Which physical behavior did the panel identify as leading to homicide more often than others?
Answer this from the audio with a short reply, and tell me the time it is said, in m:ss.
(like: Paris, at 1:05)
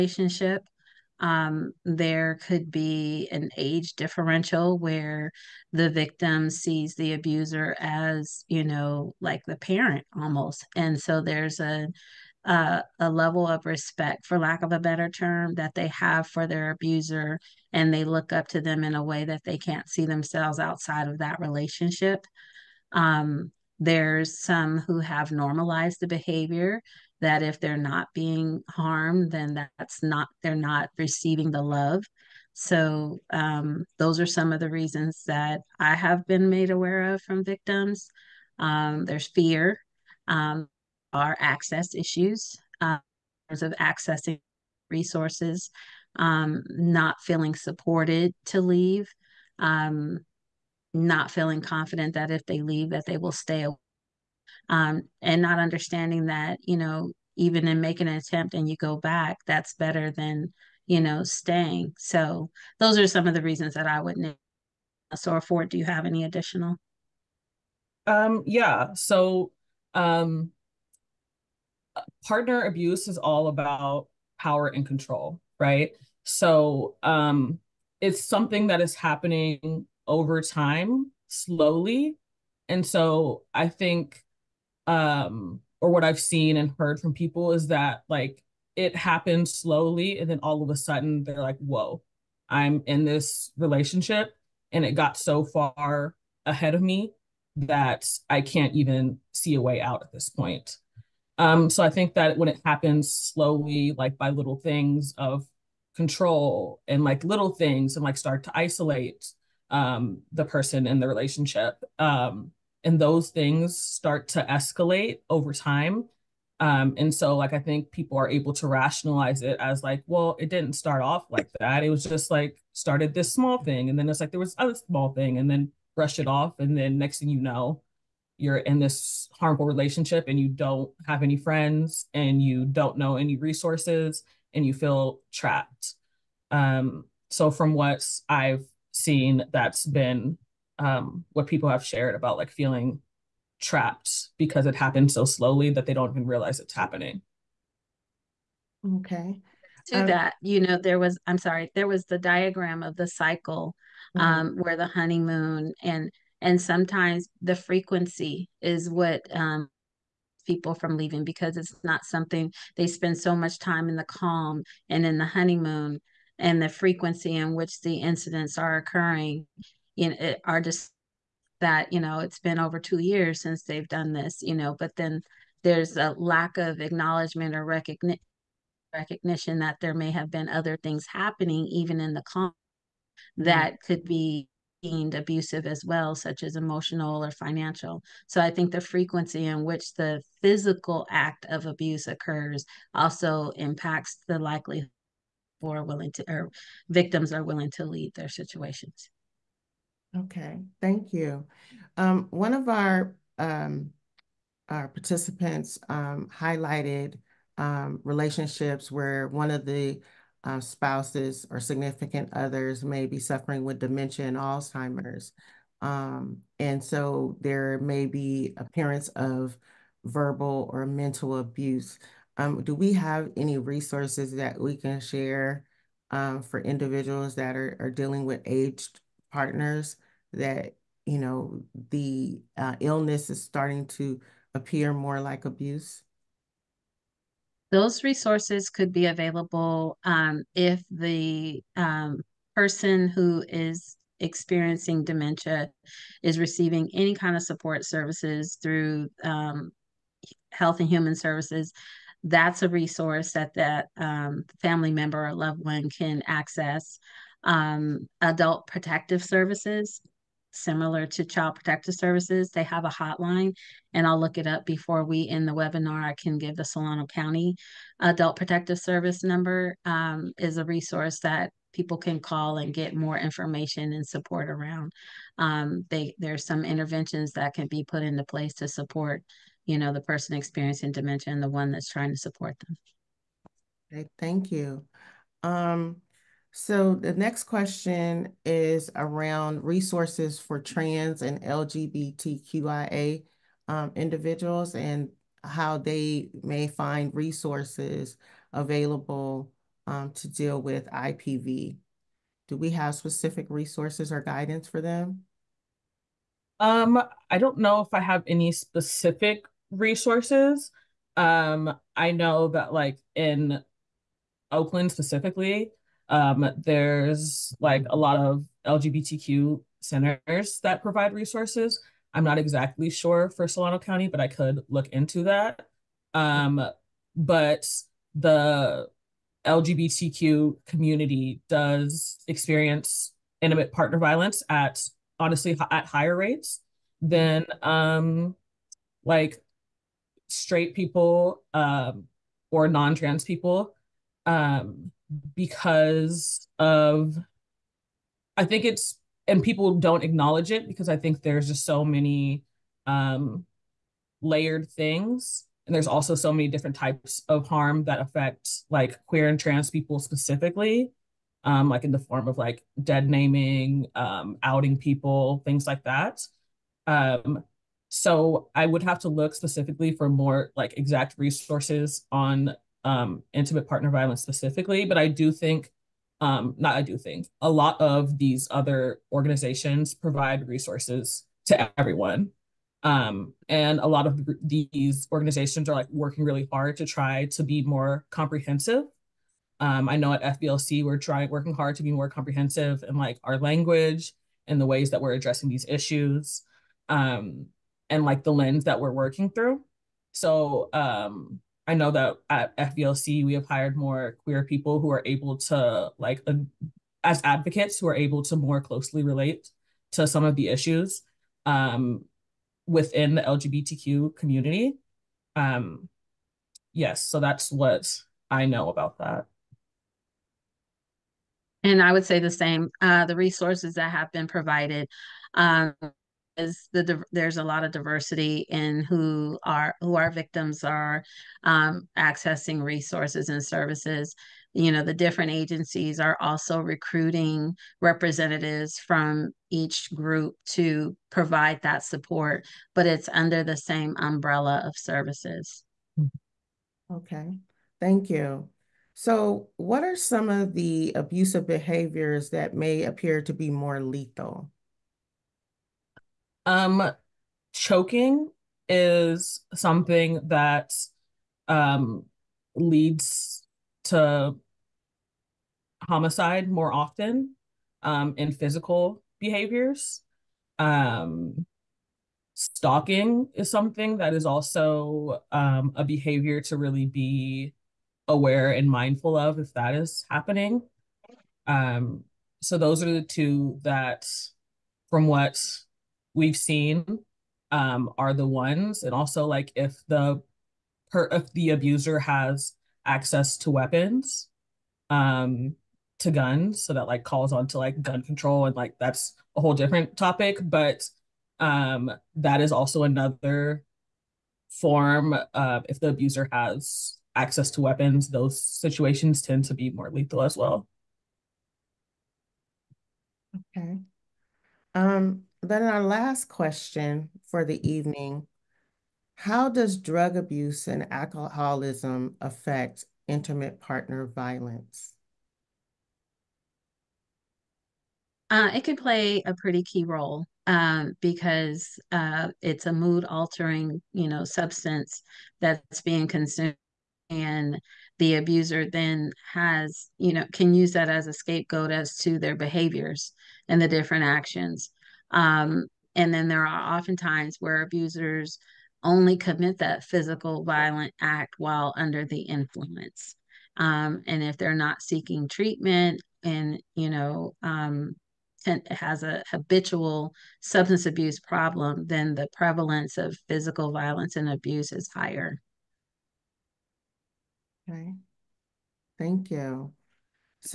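Choking, at 7:37.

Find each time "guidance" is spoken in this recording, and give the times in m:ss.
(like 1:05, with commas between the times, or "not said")
5:04.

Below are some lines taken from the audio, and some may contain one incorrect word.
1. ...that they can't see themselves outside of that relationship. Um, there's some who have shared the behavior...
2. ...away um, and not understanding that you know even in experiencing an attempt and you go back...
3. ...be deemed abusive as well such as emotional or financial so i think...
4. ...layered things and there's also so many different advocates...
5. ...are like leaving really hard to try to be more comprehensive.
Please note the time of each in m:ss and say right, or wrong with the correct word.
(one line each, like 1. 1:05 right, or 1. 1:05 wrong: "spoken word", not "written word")
1. 0:19 wrong: "normalized", not "shared"
2. 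0:53 wrong: "making", not "experiencing"
3. 3:04 right
4. 5:54 wrong: "types", not "advocates"
5. 6:25 wrong: "working", not "leaving".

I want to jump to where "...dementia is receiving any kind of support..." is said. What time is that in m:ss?
4:05.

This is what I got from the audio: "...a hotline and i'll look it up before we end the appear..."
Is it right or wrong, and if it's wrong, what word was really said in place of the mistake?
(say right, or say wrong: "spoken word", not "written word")
wrong: "webinar", not "appear".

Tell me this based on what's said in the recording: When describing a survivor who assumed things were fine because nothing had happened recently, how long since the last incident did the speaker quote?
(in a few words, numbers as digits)
over 2 years.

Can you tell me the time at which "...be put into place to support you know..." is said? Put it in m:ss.
4:37.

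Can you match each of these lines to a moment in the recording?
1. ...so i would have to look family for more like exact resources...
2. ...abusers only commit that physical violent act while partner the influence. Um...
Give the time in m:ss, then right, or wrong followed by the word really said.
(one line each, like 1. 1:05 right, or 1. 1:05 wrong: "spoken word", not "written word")
1. 6:07 wrong: "specifically", not "family"
2. 9:07 wrong: "under", not "partner".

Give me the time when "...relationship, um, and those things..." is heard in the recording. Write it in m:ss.
1:51.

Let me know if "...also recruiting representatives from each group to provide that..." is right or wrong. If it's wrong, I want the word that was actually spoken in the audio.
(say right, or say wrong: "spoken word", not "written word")
right.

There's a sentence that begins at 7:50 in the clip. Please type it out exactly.
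Um, stalking is something that is also um, a behavior to really be aware and mindful of if that is happening.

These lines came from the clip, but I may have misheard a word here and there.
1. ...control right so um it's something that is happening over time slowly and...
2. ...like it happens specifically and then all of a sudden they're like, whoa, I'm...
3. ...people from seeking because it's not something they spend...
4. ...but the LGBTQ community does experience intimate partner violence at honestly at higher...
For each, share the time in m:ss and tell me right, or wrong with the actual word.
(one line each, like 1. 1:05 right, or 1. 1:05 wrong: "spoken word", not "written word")
1. 1:14 right
2. 1:28 wrong: "slowly", not "specifically"
3. 2:40 wrong: "leaving", not "seeking"
4. 5:27 right.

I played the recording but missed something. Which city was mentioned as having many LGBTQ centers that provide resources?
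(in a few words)
Oakland.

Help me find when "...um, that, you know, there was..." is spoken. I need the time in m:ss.
2:30.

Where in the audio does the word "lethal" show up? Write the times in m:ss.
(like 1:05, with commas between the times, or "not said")
7:33, 8:29.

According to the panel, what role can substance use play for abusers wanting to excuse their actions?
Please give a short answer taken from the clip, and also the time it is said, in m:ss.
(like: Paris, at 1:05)
A scapegoat, at 9:01.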